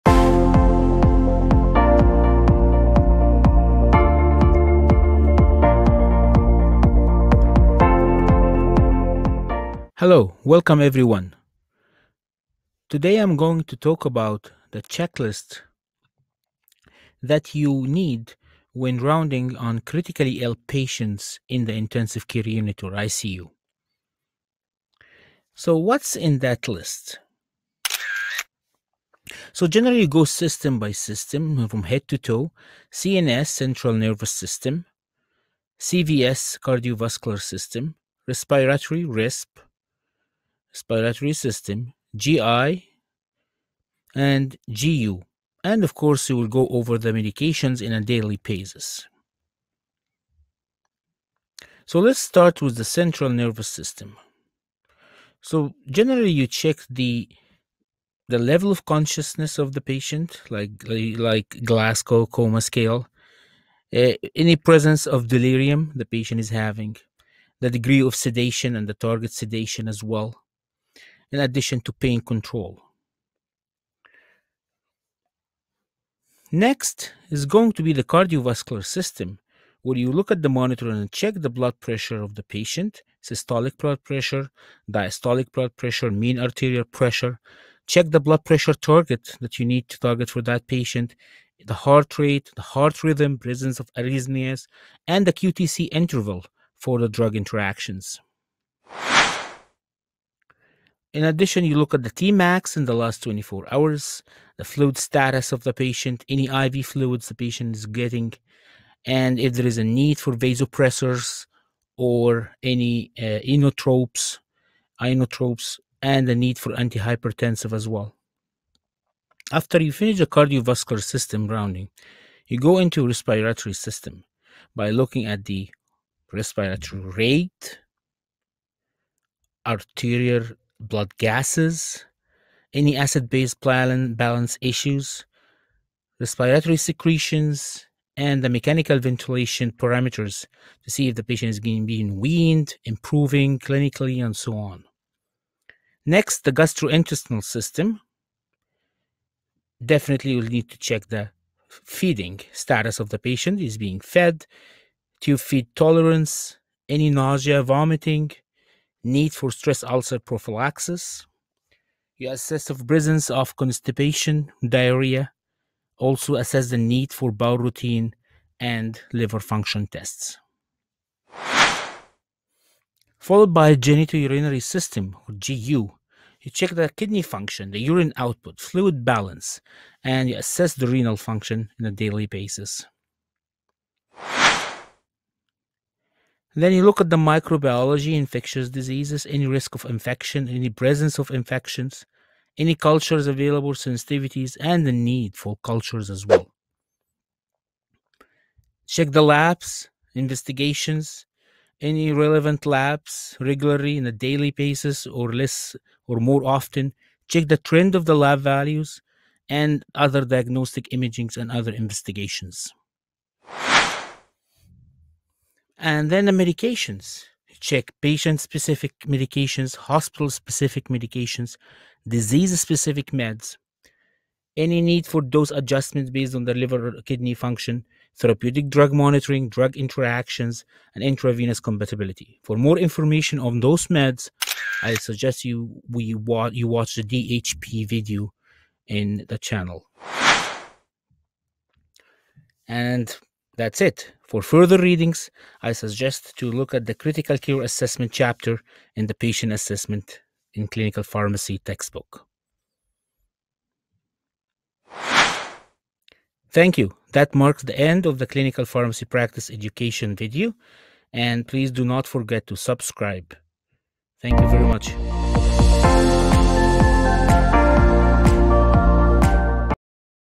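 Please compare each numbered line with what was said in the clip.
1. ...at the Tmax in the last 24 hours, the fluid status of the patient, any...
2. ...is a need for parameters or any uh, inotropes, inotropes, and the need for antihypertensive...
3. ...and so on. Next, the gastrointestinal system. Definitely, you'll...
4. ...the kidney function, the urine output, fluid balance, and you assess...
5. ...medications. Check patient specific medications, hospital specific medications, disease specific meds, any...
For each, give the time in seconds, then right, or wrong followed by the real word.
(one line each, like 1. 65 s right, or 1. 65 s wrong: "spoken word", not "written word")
1. 101 s right
2. 109 s wrong: "vasopressors", not "parameters"
3. 144 s right
4. 176 s right
5. 216 s right.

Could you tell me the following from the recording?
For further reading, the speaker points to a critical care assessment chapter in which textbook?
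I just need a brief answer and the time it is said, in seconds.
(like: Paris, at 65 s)
Patient Assessment in Clinical Pharmacy, at 249 s.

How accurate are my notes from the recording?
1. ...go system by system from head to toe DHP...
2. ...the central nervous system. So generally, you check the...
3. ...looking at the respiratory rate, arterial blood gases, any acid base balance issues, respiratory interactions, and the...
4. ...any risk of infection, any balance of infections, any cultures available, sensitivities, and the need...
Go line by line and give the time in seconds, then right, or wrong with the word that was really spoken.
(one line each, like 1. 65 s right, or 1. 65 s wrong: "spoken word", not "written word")
1. 30 s wrong: "CNS", not "DHP"
2. 52 s right
3. 124 s wrong: "secretions", not "interactions"
4. 189 s wrong: "presence", not "balance".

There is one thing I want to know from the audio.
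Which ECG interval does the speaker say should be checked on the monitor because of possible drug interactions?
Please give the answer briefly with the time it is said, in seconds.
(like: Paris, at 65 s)
QTc interval, at 95 s.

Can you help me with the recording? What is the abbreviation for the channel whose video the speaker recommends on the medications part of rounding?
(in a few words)
DHP.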